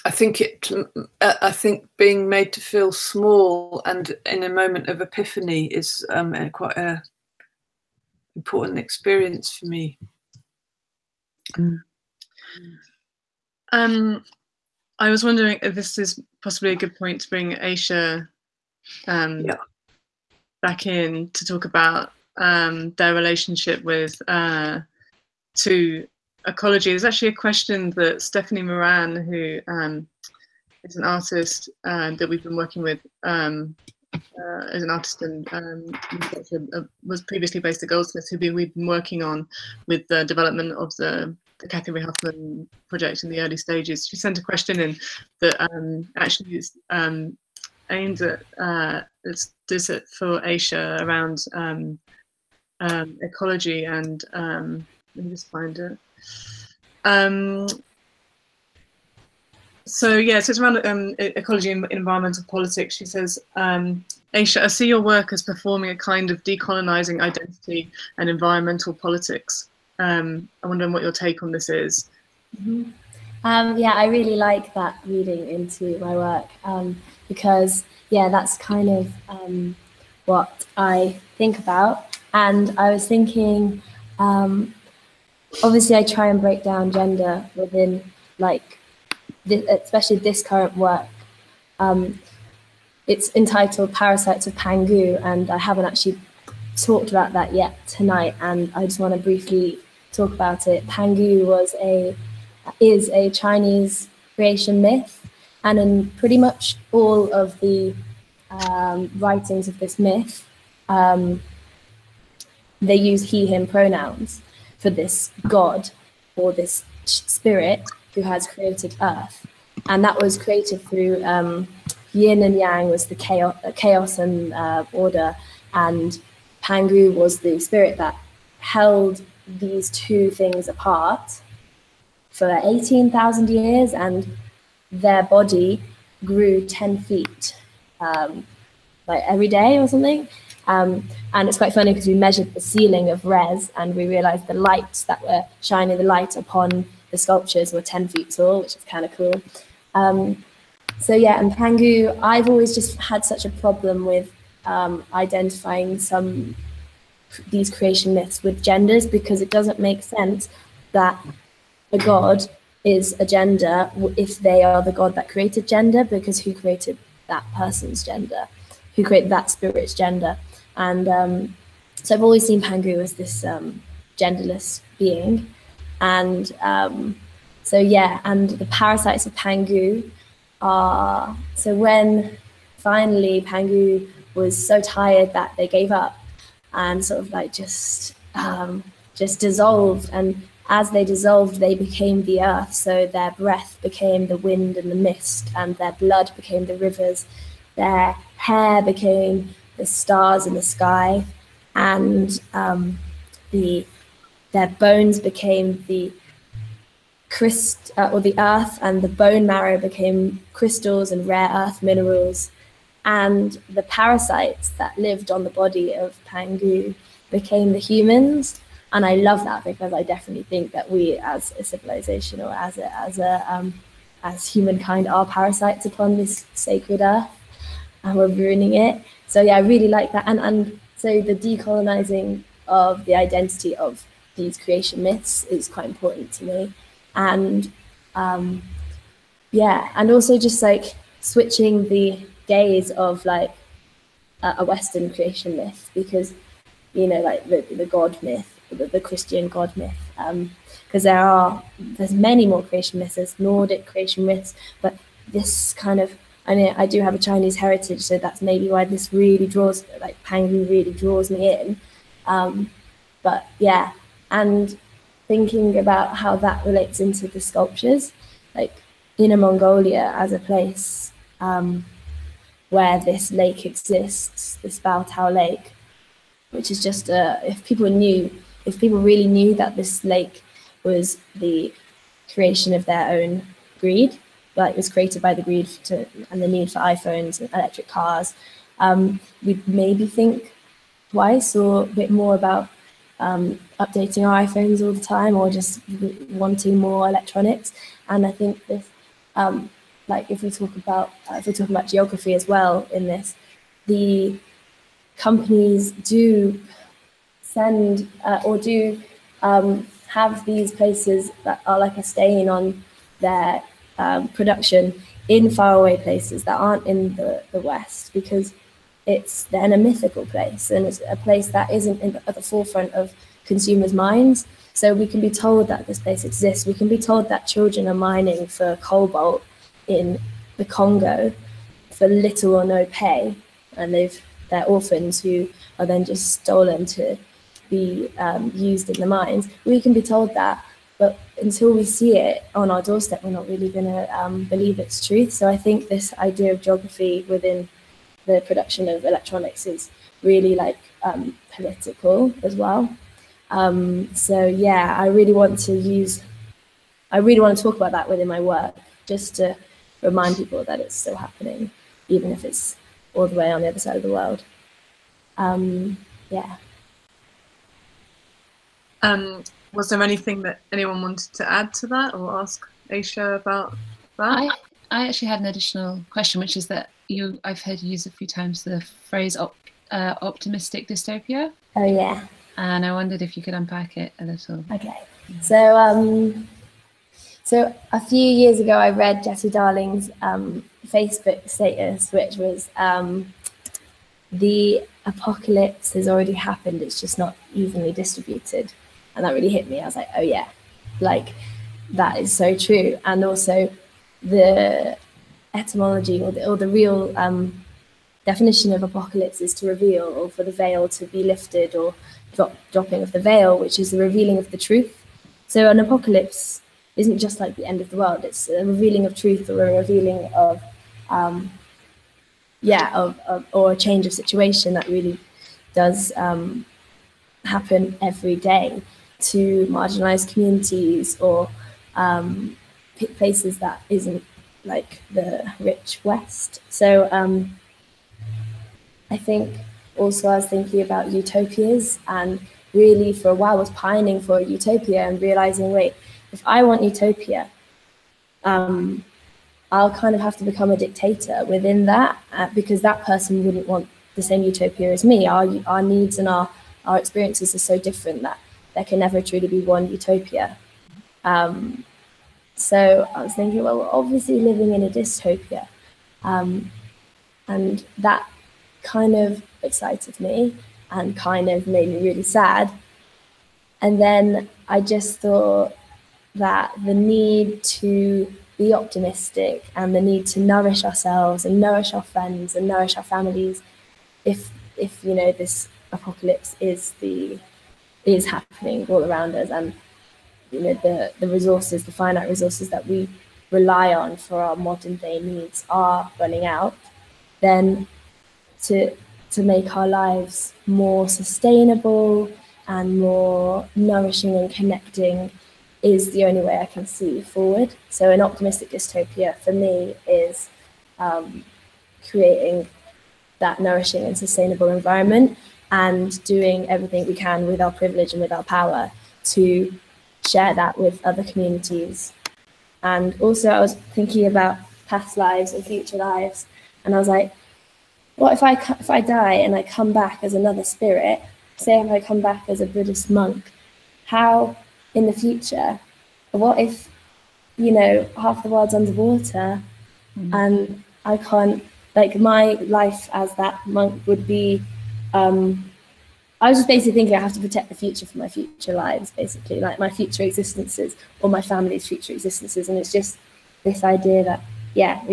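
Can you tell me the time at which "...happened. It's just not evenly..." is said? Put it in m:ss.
6:36.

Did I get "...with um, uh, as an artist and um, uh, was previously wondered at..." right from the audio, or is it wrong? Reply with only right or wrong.
wrong.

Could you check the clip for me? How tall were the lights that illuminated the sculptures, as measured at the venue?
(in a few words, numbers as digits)
10 feet.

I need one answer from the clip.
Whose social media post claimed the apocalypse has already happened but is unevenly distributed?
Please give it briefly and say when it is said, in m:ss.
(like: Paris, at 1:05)
Jesse Darling, at 6:29.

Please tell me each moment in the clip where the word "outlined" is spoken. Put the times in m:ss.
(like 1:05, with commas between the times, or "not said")
not said.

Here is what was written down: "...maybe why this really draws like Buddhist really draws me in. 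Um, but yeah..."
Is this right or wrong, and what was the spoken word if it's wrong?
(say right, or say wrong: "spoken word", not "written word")
wrong: "Pangu", not "Buddhist".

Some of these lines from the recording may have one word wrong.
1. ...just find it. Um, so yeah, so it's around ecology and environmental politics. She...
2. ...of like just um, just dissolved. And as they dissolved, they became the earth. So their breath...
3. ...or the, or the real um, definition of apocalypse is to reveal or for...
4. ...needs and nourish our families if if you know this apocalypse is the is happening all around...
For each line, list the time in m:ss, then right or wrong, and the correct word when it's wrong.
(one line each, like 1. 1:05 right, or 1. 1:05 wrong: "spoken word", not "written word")
1. 0:55 right
2. 3:07 right
3. 6:46 right
4. 8:02 wrong: "friends", not "needs".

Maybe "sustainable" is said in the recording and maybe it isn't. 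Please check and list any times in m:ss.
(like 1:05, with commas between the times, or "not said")
8:21, 8:34.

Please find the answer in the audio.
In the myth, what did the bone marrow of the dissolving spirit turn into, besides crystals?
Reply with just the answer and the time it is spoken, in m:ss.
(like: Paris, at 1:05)
rare earth minerals, at 3:31.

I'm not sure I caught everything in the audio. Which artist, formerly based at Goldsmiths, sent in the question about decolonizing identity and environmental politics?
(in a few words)
Stephanie Moran.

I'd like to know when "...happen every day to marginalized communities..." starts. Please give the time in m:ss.
7:07.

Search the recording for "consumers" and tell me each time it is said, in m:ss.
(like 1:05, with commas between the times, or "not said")
5:23.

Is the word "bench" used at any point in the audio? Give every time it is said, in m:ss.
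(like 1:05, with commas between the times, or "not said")
not said.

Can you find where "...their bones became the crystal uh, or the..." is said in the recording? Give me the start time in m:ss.
3:24.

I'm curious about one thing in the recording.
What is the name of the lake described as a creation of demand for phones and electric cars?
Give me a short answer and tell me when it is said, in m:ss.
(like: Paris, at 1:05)
Baotou Lake, at 4:34.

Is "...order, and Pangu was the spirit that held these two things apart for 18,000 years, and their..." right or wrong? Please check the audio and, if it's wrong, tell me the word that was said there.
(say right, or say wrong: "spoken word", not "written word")
right.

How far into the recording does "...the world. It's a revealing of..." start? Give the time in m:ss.
6:57.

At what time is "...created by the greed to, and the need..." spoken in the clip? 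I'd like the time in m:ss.
4:44.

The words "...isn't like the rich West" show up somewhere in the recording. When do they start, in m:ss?
7:13.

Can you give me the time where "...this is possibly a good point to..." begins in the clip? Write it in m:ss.
0:15.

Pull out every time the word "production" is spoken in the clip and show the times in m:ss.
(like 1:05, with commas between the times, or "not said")
5:14, 5:48.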